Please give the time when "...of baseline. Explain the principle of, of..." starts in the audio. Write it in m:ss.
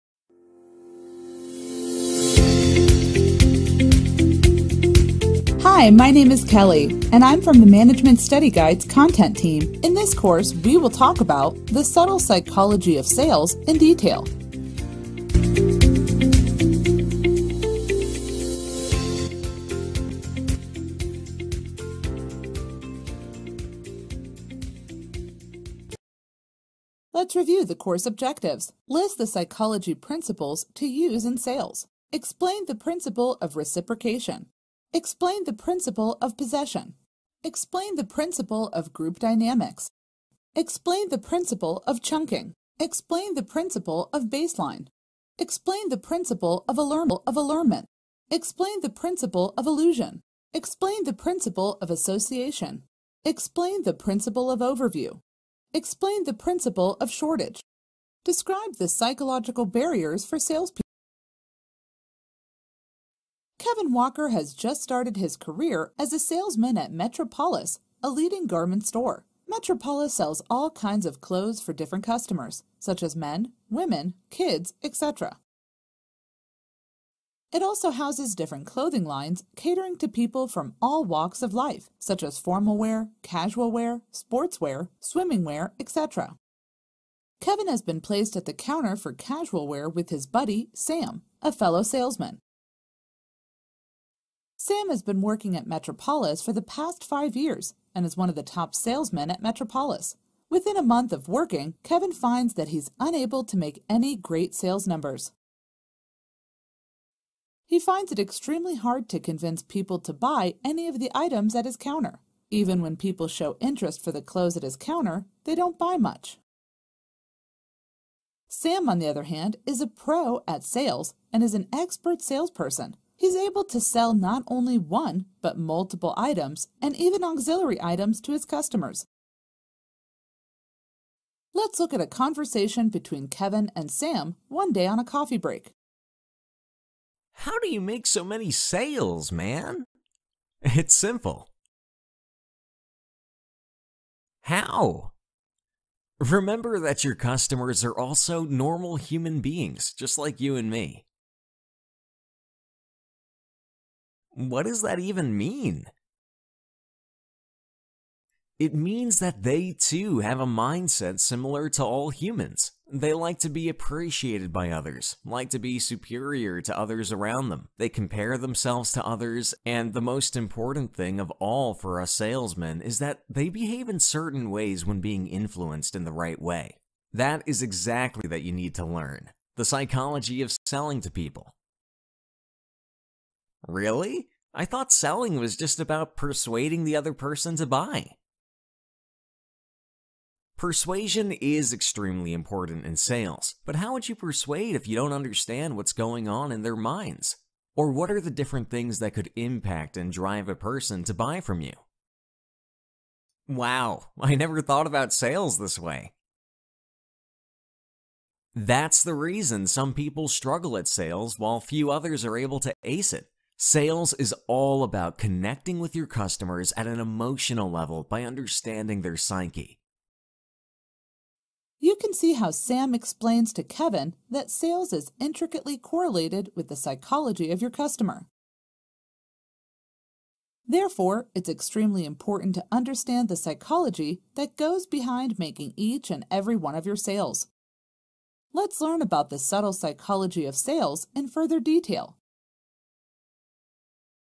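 0:44.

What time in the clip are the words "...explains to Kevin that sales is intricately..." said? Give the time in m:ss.
3:42.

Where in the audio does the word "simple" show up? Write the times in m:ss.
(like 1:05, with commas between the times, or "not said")
2:20.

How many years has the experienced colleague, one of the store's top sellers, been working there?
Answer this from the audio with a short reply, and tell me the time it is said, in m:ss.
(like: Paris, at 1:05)
5, at 1:37.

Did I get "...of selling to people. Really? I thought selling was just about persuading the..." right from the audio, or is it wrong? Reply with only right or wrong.
right.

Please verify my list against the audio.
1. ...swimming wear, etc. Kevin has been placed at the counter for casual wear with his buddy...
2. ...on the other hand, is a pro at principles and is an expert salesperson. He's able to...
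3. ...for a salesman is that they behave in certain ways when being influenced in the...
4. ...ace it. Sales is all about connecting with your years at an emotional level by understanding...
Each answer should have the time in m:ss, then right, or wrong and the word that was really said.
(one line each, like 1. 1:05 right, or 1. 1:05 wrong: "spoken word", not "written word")
1. 1:24 right
2. 1:58 wrong: "sales", not "principles"
3. 2:51 right
4. 3:32 wrong: "customers", not "years".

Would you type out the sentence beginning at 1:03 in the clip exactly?
Kevin Walker has just started his career as a salesman at Metropolis, a leading garment store.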